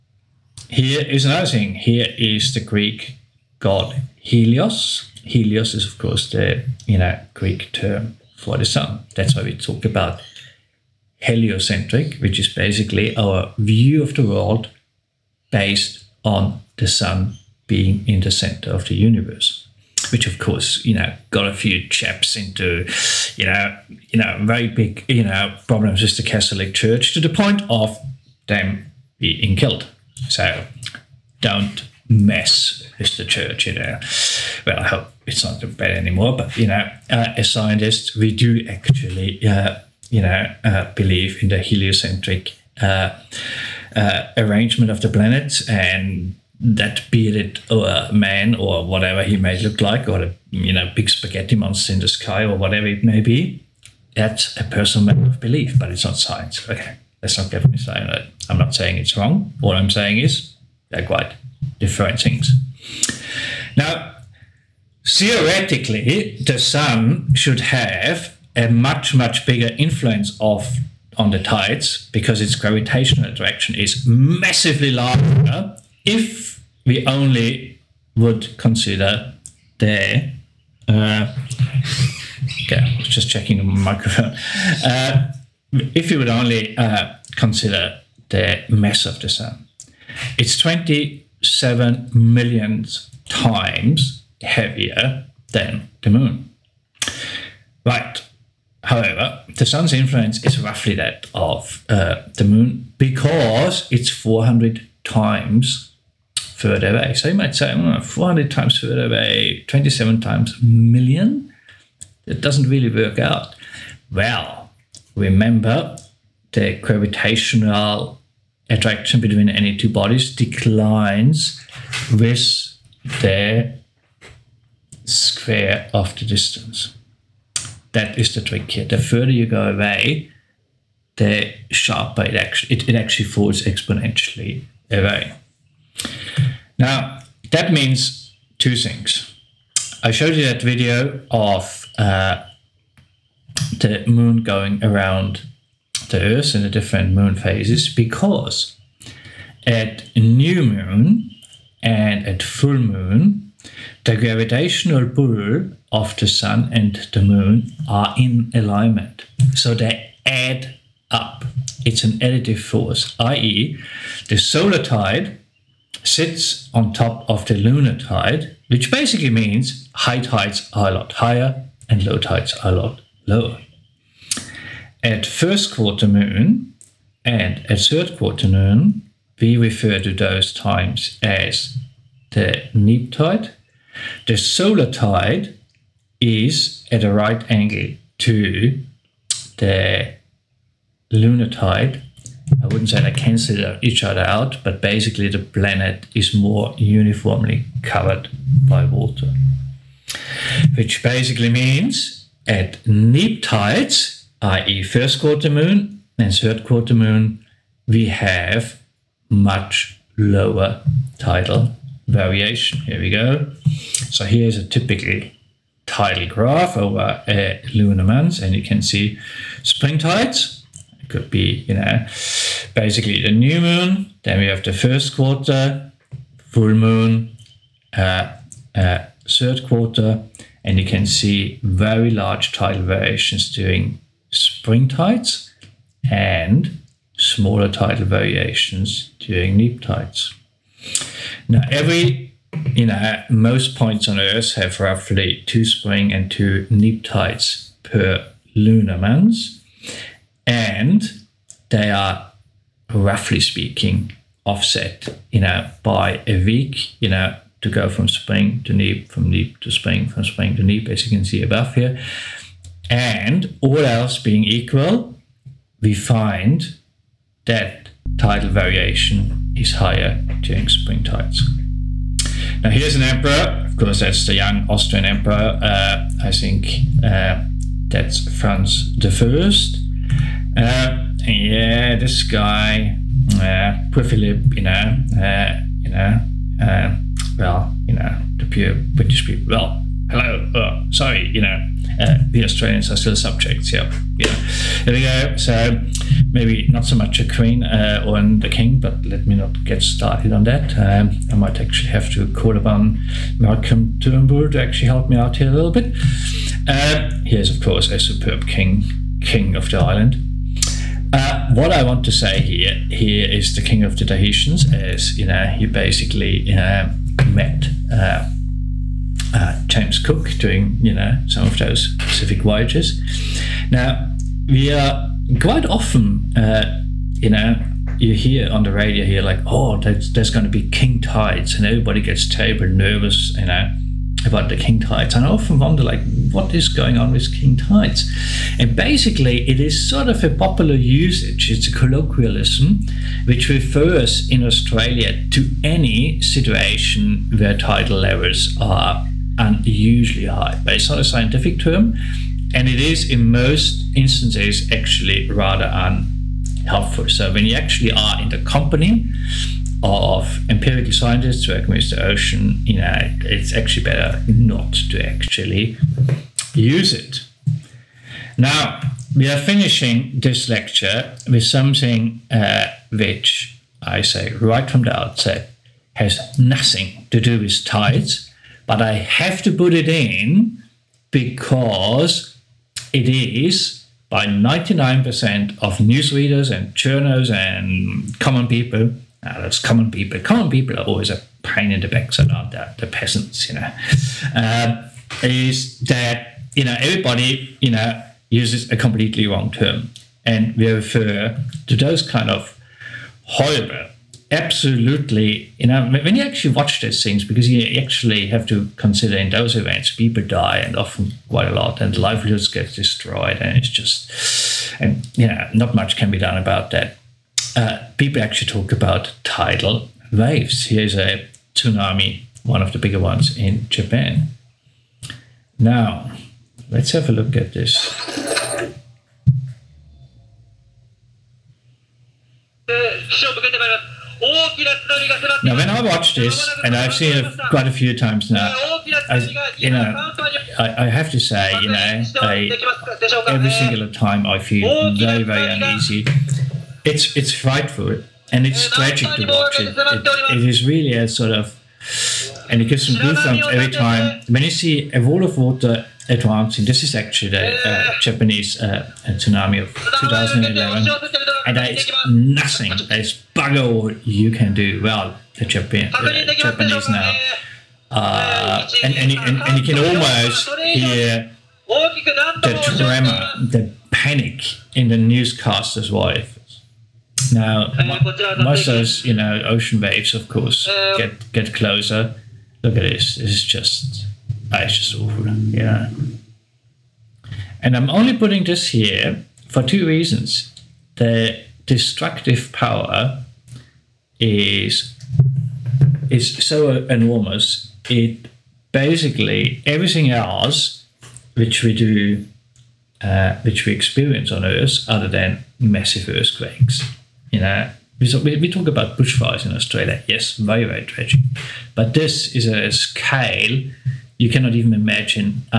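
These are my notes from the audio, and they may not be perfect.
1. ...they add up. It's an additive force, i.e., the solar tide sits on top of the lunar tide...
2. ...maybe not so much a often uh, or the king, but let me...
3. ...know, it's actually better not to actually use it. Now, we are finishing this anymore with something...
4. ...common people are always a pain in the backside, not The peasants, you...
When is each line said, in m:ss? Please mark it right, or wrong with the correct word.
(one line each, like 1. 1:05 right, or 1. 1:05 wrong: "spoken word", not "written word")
1. 2:39 right
2. 4:56 wrong: "queen", not "often"
3. 6:02 wrong: "lecture", not "anymore"
4. 6:30 right.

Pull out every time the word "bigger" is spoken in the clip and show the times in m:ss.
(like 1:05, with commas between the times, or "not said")
1:09, 7:02.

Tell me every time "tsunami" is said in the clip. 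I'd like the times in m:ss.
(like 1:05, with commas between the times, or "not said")
7:01, 7:39.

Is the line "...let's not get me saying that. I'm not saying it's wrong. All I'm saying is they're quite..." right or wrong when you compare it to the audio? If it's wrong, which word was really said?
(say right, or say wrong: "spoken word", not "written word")
right.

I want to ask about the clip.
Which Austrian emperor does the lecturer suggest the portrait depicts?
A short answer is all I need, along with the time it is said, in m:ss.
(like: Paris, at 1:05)
Franz the First, at 4:38.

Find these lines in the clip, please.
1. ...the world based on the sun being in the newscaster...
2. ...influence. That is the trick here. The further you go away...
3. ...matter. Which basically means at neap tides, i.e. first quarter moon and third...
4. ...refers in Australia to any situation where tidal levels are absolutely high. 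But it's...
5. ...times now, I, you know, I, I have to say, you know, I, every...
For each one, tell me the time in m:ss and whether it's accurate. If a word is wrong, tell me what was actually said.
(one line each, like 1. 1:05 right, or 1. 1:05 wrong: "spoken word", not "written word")
1. 0:14 wrong: "center", not "newscaster"
2. 2:06 wrong: "distance", not "influence"
3. 3:18 wrong: "water", not "matter"
4. 5:43 wrong: "unusually", not "absolutely"
5. 7:17 right.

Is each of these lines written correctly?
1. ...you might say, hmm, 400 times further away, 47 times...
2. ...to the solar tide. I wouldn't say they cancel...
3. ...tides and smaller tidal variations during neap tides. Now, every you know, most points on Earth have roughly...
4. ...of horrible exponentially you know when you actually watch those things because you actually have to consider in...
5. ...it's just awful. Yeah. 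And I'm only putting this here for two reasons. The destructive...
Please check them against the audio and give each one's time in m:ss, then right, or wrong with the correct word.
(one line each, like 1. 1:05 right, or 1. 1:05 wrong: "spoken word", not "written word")
1. 1:47 wrong: "27", not "47"
2. 3:08 wrong: "lunar", not "solar"
3. 3:54 right
4. 6:42 wrong: "absolutely", not "exponentially"
5. 8:04 right.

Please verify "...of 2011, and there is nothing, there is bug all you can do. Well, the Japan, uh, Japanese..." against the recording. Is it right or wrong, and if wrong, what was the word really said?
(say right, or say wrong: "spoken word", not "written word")
right.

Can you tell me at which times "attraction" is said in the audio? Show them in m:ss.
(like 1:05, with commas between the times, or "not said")
1:13, 1:58.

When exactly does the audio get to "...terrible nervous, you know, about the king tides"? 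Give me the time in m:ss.
5:32.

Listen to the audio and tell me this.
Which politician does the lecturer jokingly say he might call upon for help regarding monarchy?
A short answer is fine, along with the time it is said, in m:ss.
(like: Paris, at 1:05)
Malcolm Turnbull, at 5:03.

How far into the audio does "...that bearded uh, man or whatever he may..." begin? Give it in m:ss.
0:46.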